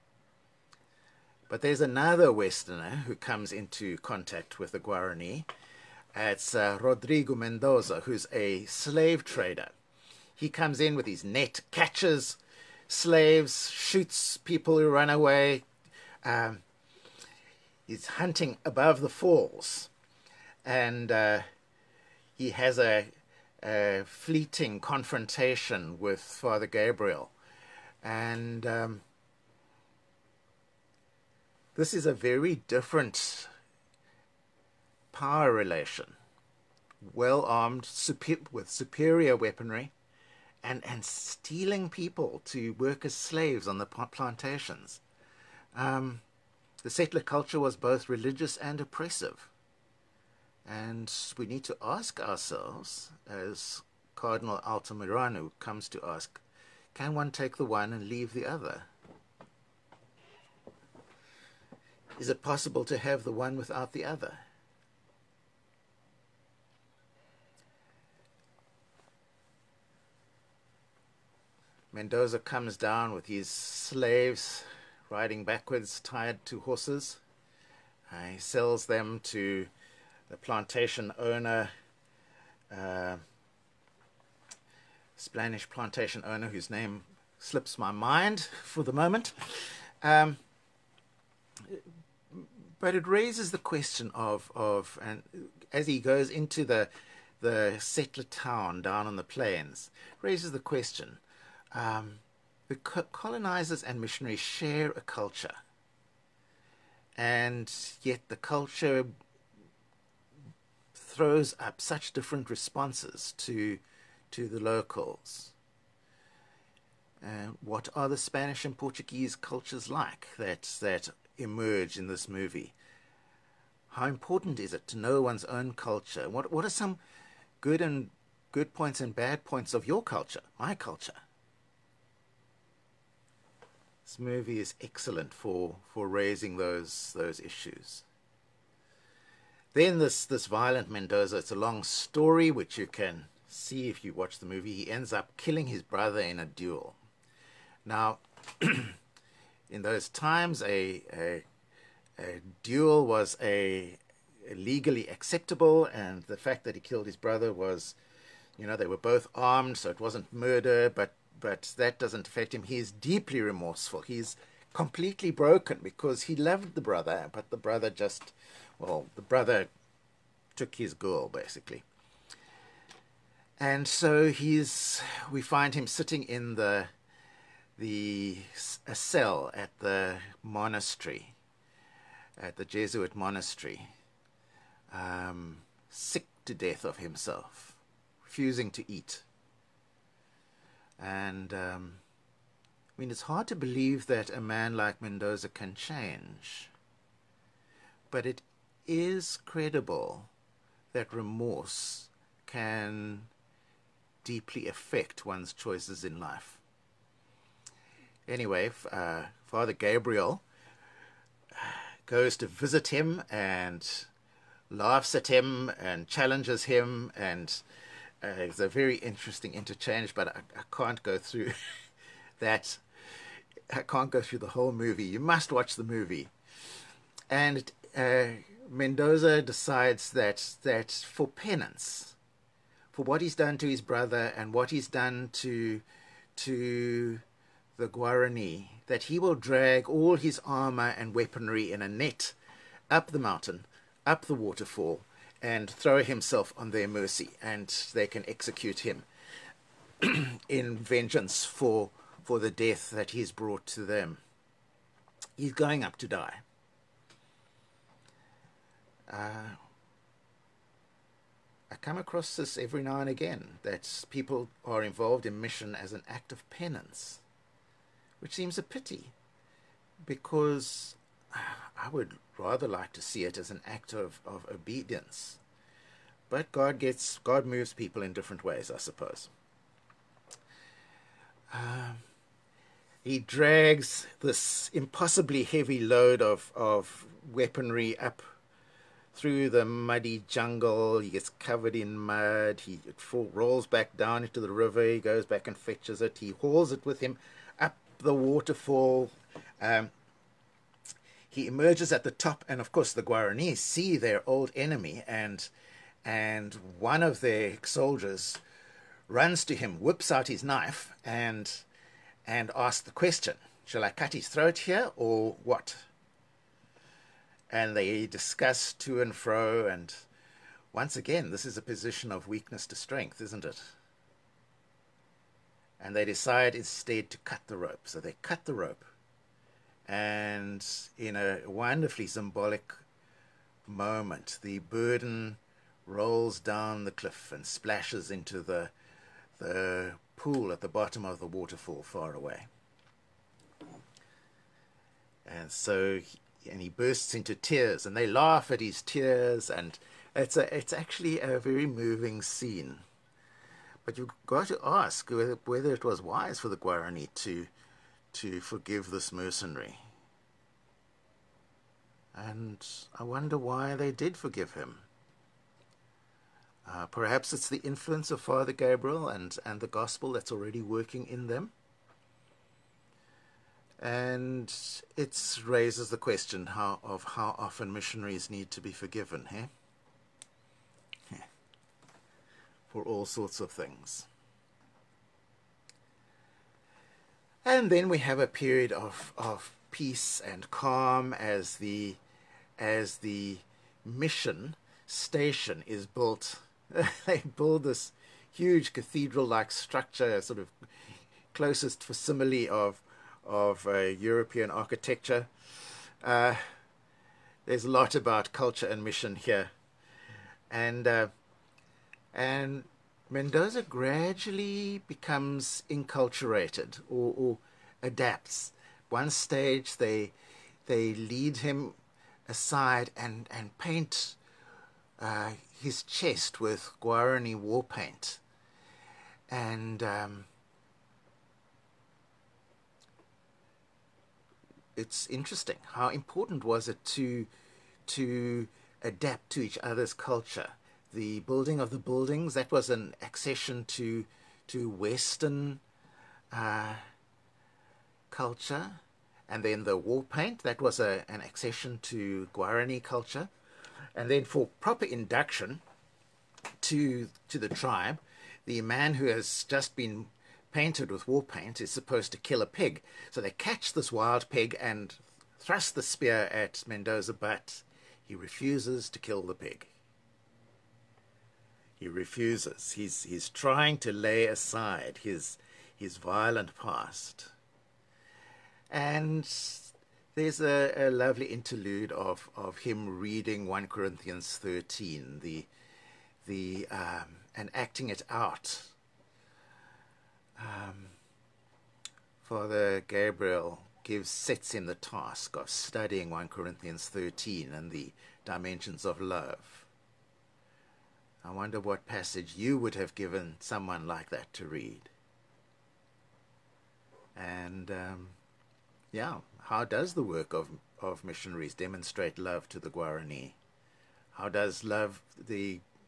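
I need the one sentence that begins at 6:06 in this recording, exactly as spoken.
Uh, perhaps it's the influence of Father Gabriel and, and the gospel that's already working in them.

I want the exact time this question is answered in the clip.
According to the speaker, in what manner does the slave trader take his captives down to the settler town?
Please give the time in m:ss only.
1:15.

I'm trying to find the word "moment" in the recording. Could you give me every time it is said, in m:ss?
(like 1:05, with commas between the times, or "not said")
1:28, 5:33.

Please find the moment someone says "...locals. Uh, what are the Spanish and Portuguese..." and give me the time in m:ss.
1:54.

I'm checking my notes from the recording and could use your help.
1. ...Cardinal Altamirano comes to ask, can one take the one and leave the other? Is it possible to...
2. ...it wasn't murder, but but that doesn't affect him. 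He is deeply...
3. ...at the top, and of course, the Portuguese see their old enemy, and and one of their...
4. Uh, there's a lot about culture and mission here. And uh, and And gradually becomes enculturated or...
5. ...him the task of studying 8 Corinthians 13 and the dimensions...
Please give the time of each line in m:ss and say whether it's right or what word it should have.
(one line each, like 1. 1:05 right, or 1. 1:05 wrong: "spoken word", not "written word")
1. 0:54 right
2. 2:39 right
3. 5:01 wrong: "Guaranis", not "Portuguese"
4. 6:46 wrong: "Mendoza", not "And"
5. 8:14 wrong: "1", not "8".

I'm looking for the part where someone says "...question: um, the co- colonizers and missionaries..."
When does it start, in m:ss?
1:40.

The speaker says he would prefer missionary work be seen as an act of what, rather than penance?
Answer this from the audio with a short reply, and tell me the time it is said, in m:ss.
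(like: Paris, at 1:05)
Obedience, at 4:34.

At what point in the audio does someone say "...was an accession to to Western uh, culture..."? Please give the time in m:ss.
7:22.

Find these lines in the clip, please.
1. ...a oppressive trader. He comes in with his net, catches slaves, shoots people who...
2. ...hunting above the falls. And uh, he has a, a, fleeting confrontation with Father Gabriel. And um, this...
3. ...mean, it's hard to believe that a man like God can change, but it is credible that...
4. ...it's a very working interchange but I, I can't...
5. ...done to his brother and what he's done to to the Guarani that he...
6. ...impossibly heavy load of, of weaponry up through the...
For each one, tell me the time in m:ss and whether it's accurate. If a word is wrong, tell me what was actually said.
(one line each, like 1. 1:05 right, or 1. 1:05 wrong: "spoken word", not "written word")
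1. 0:08 wrong: "slave", not "oppressive"
2. 0:18 right
3. 3:13 wrong: "Mendoza", not "God"
4. 3:38 wrong: "interesting", not "working"
5. 3:53 right
6. 4:44 right.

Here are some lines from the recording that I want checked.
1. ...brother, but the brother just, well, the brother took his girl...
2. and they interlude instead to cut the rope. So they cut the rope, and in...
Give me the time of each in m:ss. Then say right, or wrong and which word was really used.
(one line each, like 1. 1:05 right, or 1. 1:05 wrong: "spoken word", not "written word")
1. 2:46 right
2. 5:25 wrong: "decide", not "interlude".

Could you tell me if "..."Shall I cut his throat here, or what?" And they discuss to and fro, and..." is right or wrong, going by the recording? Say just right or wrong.
right.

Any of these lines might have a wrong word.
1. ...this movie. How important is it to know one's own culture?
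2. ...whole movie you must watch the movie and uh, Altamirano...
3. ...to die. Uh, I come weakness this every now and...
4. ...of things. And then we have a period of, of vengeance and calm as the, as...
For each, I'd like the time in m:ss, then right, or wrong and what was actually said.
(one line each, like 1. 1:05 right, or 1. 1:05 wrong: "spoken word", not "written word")
1. 2:02 right
2. 3:44 wrong: "Mendoza", not "Altamirano"
3. 4:15 wrong: "across", not "weakness"
4. 6:23 wrong: "peace", not "vengeance".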